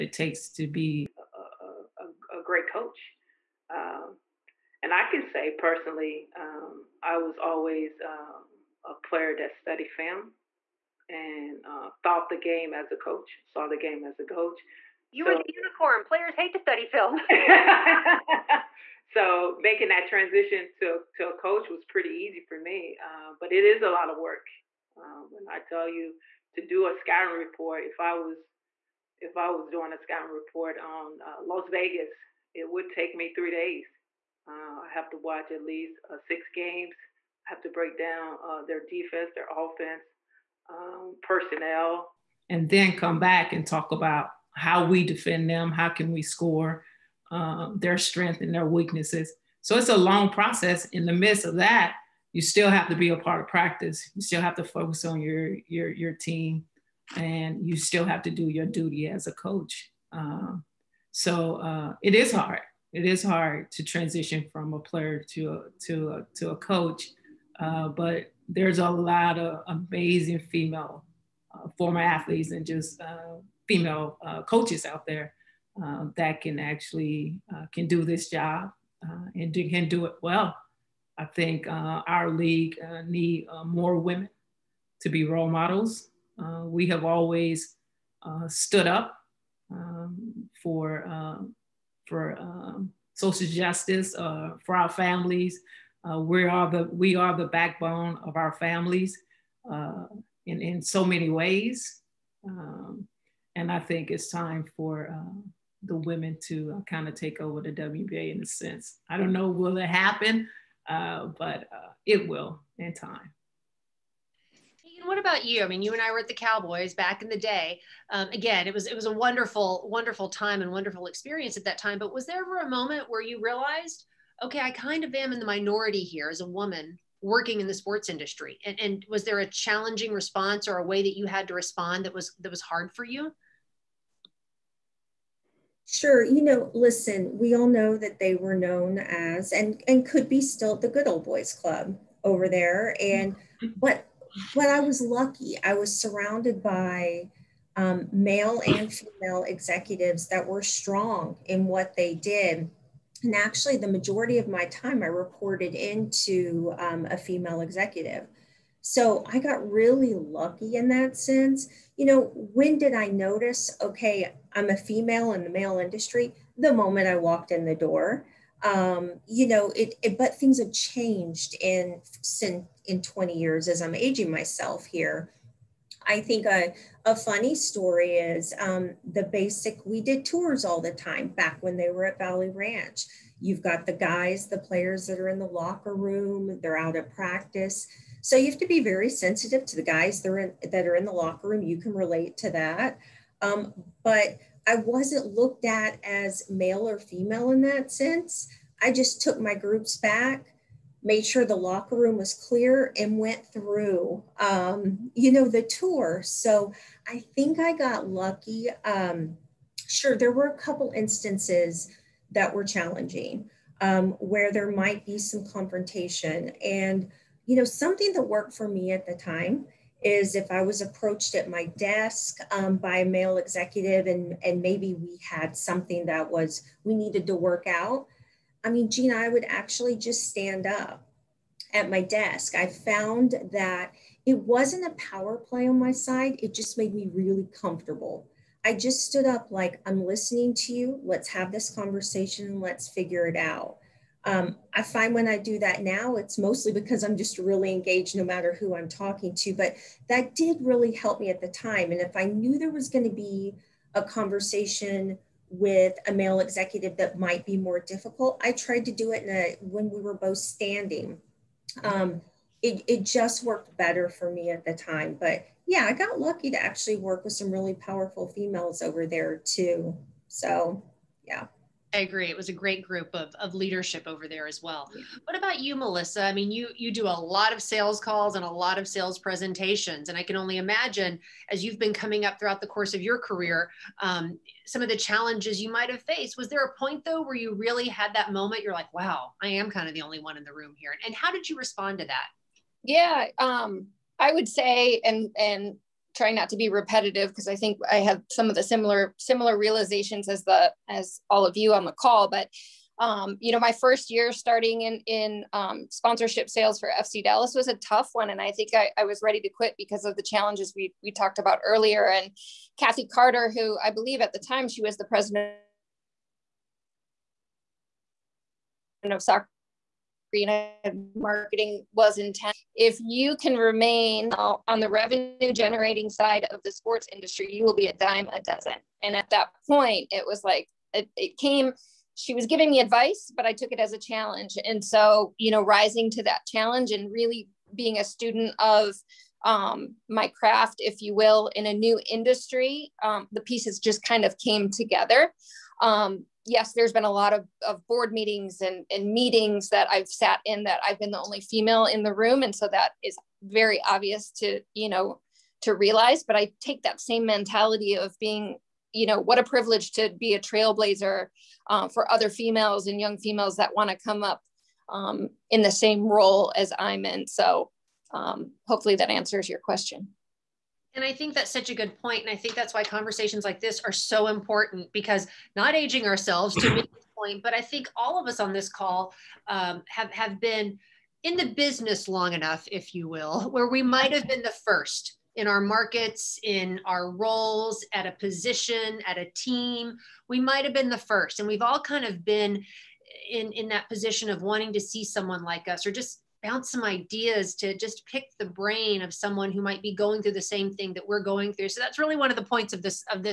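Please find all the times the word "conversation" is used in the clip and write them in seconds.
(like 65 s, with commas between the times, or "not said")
241 s, 254 s, 372 s.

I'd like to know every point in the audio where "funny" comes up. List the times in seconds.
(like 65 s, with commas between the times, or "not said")
177 s.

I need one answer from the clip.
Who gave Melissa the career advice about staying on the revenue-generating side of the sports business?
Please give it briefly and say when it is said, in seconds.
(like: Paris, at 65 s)
Kathy Carter, at 312 s.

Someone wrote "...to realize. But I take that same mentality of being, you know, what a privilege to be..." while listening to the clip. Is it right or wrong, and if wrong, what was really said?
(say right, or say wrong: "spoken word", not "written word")
right.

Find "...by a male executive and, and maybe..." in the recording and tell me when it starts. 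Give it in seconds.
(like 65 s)
222 s.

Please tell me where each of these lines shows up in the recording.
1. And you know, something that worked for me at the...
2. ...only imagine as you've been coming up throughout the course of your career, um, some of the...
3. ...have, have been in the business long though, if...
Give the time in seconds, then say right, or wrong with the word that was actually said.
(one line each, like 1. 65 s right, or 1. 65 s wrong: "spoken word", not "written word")
1. 216 s right
2. 280 s right
3. 379 s wrong: "enough", not "though".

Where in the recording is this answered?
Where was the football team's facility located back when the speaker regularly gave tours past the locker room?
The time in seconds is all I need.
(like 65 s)
182 s.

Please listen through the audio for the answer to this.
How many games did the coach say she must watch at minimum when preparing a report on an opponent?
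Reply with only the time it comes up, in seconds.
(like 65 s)
36 s.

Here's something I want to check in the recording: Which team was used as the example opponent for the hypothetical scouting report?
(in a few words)
Las Vegas.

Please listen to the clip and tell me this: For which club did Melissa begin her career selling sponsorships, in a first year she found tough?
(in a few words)
FC Dallas.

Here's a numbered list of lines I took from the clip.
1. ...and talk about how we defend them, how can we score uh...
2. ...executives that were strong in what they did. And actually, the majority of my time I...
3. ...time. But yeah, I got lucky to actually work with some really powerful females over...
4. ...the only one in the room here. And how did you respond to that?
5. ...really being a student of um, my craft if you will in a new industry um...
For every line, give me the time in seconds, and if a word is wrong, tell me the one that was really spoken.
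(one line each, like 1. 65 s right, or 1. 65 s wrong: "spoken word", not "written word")
1. 43 s right
2. 149 s right
3. 264 s right
4. 289 s right
5. 337 s right.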